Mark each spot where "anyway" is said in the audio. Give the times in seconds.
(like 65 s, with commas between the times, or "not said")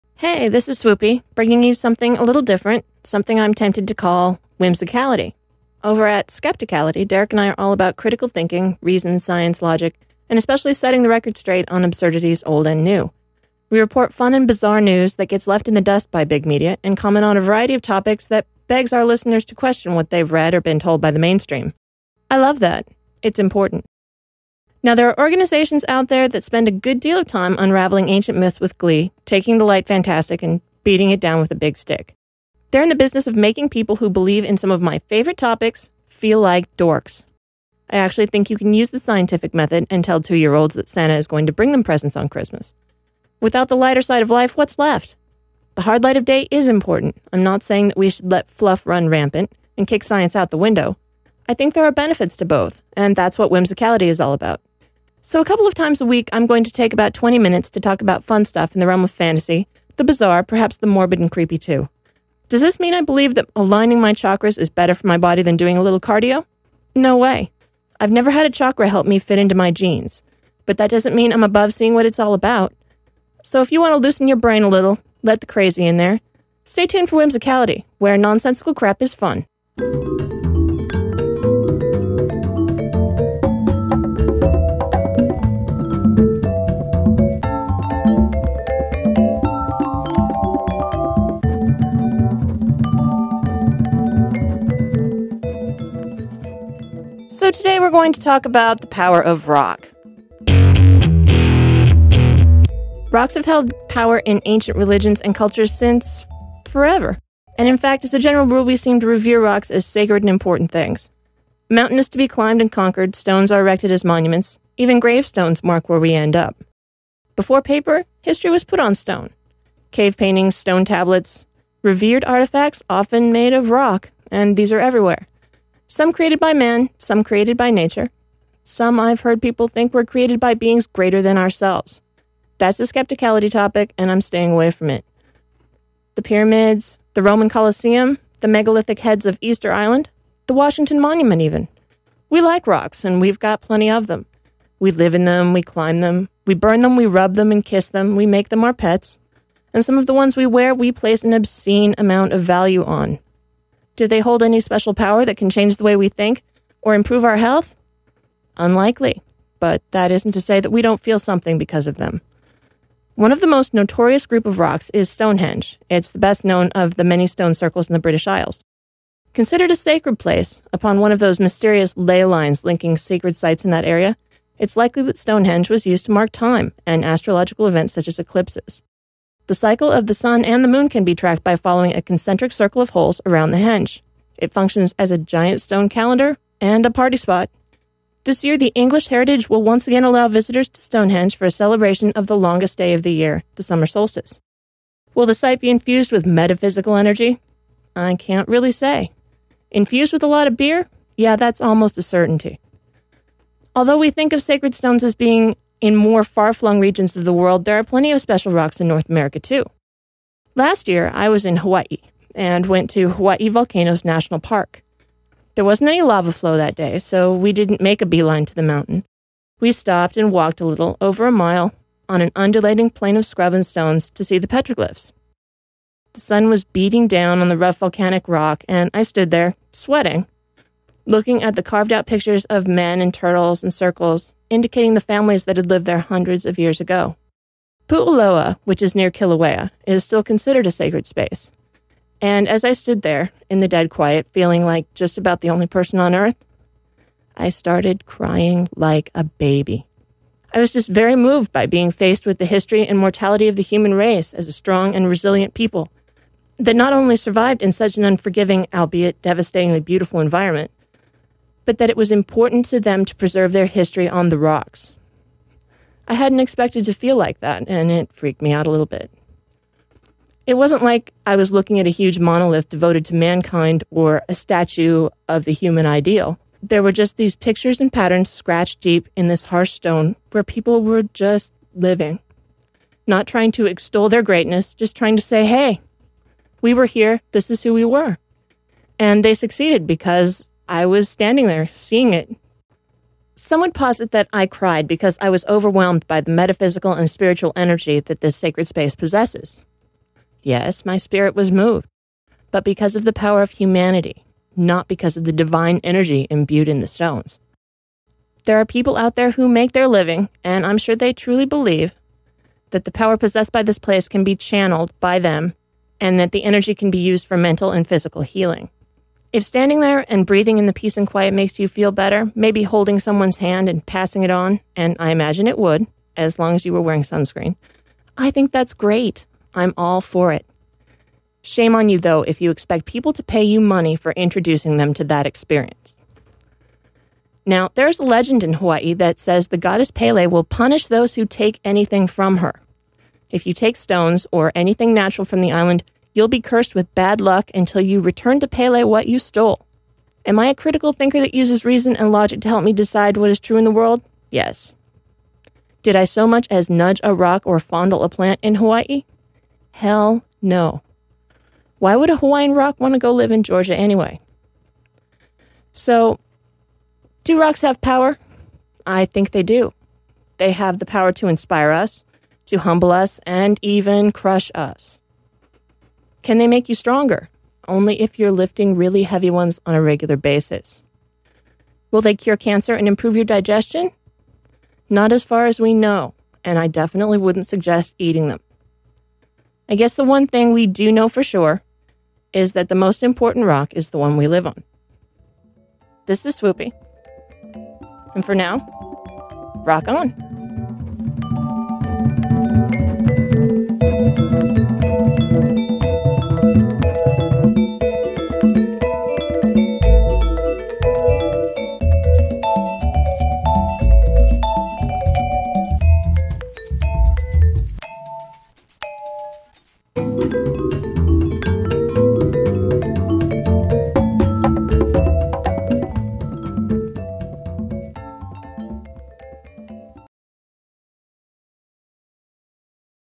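363 s.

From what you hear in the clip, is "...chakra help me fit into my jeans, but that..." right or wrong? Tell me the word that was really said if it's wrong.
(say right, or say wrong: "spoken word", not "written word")
right.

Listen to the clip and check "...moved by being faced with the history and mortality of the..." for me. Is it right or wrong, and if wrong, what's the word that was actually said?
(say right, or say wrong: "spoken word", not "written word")
right.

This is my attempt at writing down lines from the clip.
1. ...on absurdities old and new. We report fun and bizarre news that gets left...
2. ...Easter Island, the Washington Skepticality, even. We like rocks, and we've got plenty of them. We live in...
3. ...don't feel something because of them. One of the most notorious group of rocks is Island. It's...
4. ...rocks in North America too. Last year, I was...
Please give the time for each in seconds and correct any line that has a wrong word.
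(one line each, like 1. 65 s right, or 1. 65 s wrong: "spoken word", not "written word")
1. 11 s right
2. 139 s wrong: "Monument", not "Skepticality"
3. 160 s wrong: "Stonehenge", not "Island"
4. 208 s right.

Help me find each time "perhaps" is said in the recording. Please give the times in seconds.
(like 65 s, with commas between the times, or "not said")
60 s.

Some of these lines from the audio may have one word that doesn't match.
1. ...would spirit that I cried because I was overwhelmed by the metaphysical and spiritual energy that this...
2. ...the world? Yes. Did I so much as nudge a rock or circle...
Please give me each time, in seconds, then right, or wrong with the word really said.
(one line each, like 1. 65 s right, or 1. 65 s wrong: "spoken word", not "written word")
1. 293 s wrong: "posit", not "spirit"
2. 353 s wrong: "fondle", not "circle".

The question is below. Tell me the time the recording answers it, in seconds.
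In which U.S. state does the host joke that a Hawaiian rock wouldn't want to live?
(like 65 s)
363 s.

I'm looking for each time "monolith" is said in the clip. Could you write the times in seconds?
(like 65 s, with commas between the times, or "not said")
272 s.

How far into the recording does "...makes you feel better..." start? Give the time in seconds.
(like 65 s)
321 s.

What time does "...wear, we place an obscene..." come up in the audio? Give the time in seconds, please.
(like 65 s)
150 s.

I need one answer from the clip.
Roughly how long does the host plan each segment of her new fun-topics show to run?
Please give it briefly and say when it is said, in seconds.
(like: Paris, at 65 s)
20 minutes, at 57 s.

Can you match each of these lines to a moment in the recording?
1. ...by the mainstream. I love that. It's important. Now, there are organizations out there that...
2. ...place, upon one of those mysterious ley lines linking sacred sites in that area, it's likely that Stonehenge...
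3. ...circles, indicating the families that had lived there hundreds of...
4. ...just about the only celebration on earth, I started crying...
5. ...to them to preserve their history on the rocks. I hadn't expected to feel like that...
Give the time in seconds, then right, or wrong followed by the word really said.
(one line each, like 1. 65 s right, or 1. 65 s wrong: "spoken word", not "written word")
1. 21 s right
2. 170 s right
3. 233 s right
4. 244 s wrong: "person", not "celebration"
5. 262 s right.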